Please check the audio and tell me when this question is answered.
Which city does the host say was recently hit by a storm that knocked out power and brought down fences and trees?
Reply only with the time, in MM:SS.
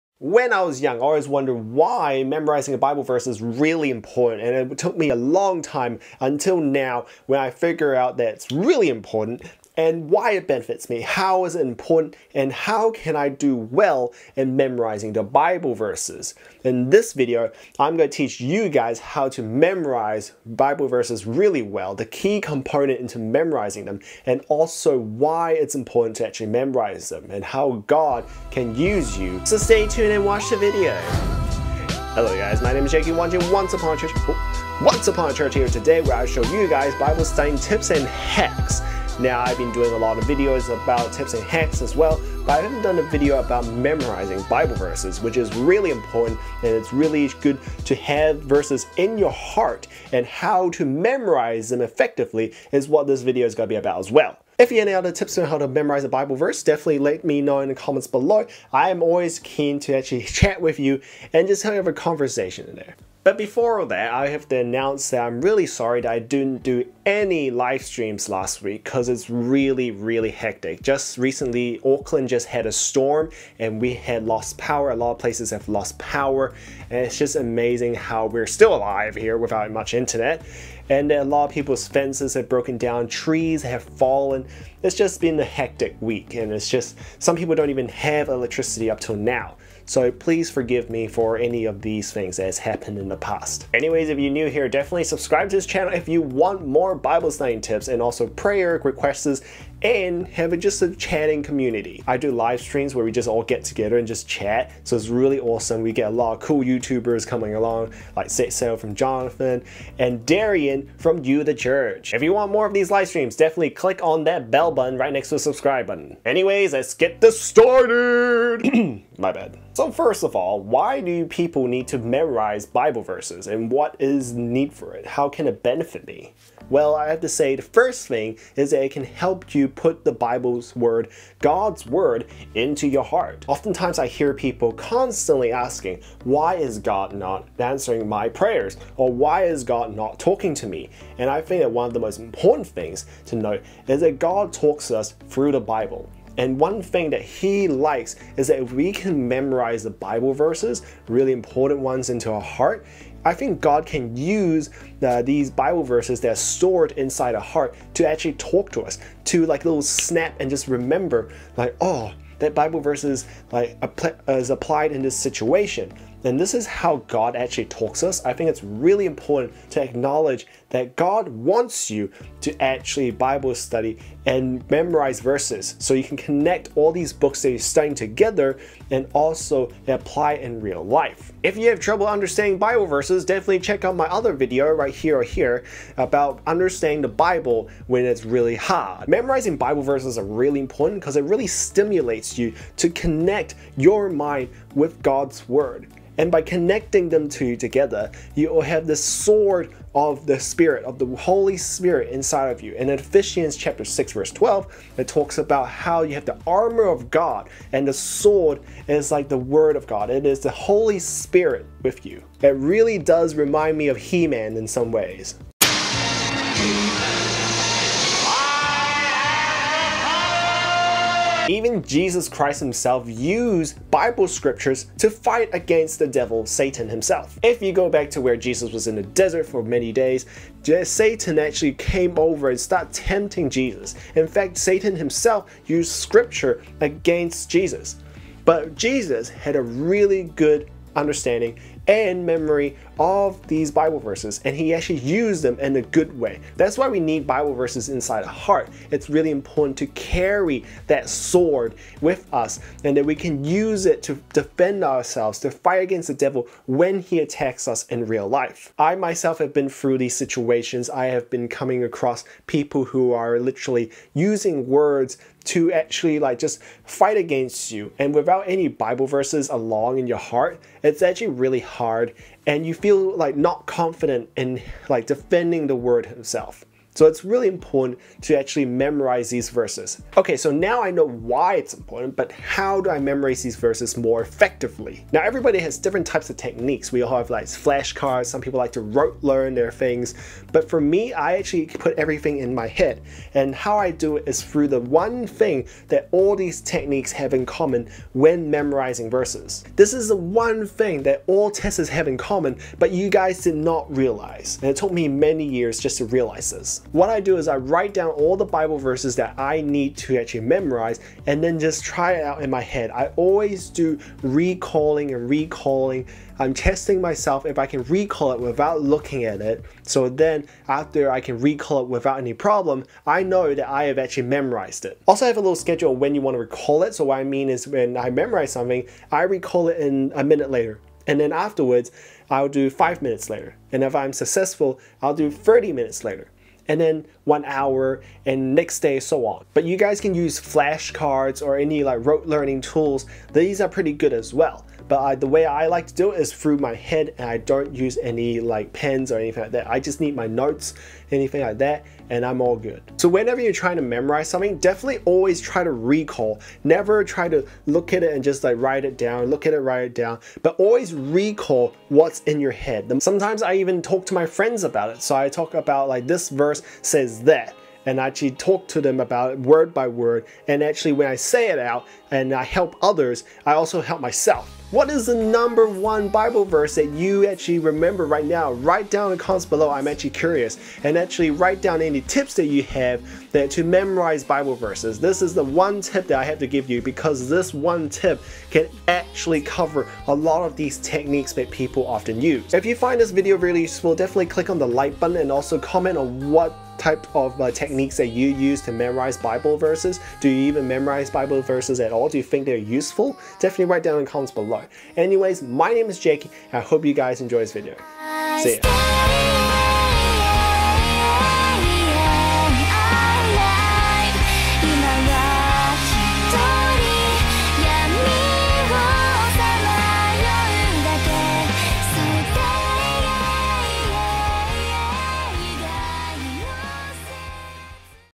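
01:11.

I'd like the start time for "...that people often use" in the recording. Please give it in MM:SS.
06:31.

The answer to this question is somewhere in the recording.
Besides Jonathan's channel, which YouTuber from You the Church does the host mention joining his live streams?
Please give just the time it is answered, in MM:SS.
01:50.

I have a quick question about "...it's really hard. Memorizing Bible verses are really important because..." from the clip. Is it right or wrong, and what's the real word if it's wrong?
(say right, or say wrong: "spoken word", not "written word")
right.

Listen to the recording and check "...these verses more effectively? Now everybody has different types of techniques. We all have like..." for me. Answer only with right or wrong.
right.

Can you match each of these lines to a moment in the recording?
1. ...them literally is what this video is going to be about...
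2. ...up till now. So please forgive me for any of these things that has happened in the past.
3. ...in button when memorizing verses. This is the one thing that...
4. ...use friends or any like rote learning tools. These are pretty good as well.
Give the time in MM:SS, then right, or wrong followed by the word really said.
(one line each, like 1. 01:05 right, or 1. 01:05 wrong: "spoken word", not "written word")
1. 00:51 wrong: "effectively", not "literally"
2. 01:28 right
3. 04:57 wrong: "common", not "button"
4. 05:40 wrong: "flashcards", not "friends".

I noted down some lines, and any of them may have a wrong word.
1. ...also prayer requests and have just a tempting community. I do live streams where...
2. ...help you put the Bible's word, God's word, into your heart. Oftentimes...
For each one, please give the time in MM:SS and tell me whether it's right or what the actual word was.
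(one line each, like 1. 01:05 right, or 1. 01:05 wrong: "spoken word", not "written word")
1. 01:38 wrong: "chatting", not "tempting"
2. 02:09 right.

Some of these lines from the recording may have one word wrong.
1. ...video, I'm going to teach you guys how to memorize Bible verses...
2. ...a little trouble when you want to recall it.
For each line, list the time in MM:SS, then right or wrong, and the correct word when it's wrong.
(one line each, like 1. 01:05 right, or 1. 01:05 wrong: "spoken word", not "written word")
1. 00:17 right
2. 05:25 wrong: "schedule", not "trouble".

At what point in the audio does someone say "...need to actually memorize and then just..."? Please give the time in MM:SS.
05:09.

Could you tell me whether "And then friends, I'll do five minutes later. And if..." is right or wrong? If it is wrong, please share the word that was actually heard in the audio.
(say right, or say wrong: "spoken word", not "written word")
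wrong: "afterwards", not "friends".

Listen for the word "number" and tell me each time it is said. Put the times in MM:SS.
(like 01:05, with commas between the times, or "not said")
06:15.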